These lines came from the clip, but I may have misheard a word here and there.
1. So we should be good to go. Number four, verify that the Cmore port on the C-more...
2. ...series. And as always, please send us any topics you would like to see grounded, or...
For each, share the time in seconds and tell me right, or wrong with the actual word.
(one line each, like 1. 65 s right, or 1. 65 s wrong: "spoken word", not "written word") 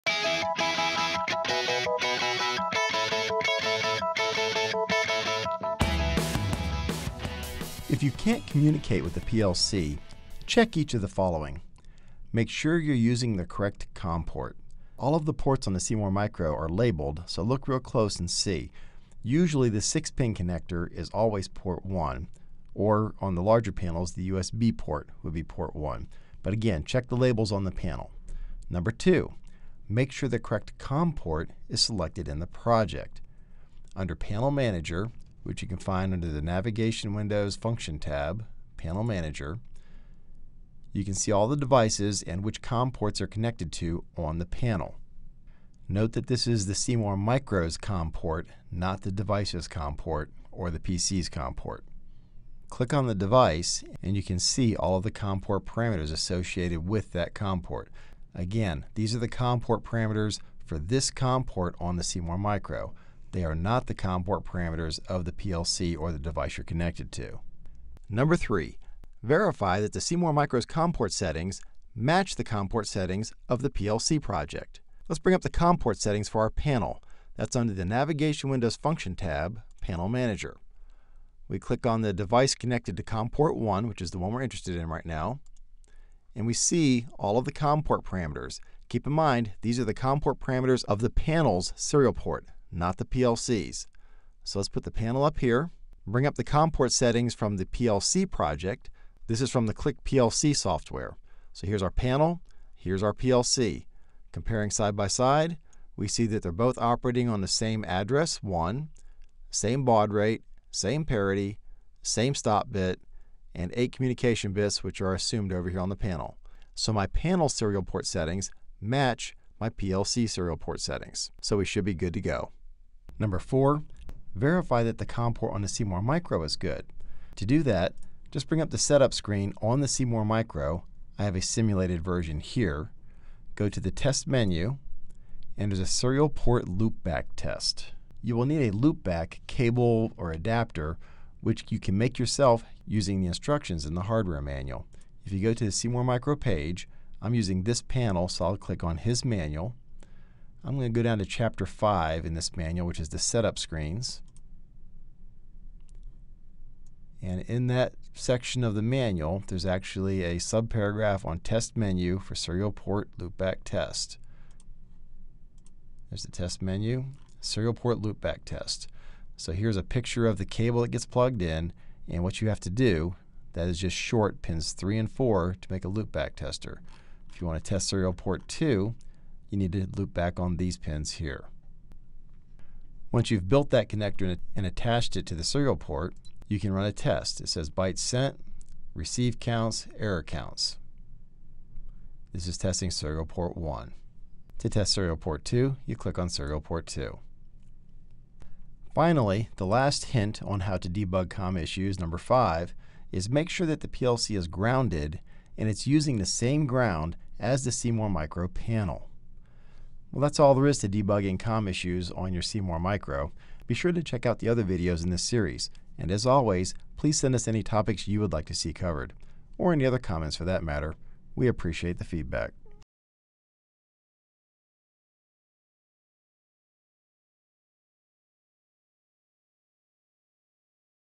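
1. 121 s wrong: "COM", not "Cmore"
2. 215 s wrong: "covered", not "grounded".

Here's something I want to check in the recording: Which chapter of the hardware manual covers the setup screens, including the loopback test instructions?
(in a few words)
Chapter 5.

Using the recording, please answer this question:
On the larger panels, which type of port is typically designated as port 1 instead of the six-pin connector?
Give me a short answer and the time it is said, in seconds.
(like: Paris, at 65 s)
USB port, at 24 s.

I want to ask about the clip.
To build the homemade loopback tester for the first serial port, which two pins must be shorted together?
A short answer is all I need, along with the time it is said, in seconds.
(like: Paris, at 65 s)
Pins 3 and 4, at 174 s.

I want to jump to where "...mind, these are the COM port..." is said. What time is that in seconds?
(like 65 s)
89 s.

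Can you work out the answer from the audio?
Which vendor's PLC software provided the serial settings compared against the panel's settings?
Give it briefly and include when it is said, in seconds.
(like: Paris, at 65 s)
Click PLC software, at 99 s.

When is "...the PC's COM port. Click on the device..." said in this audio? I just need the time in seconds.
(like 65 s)
50 s.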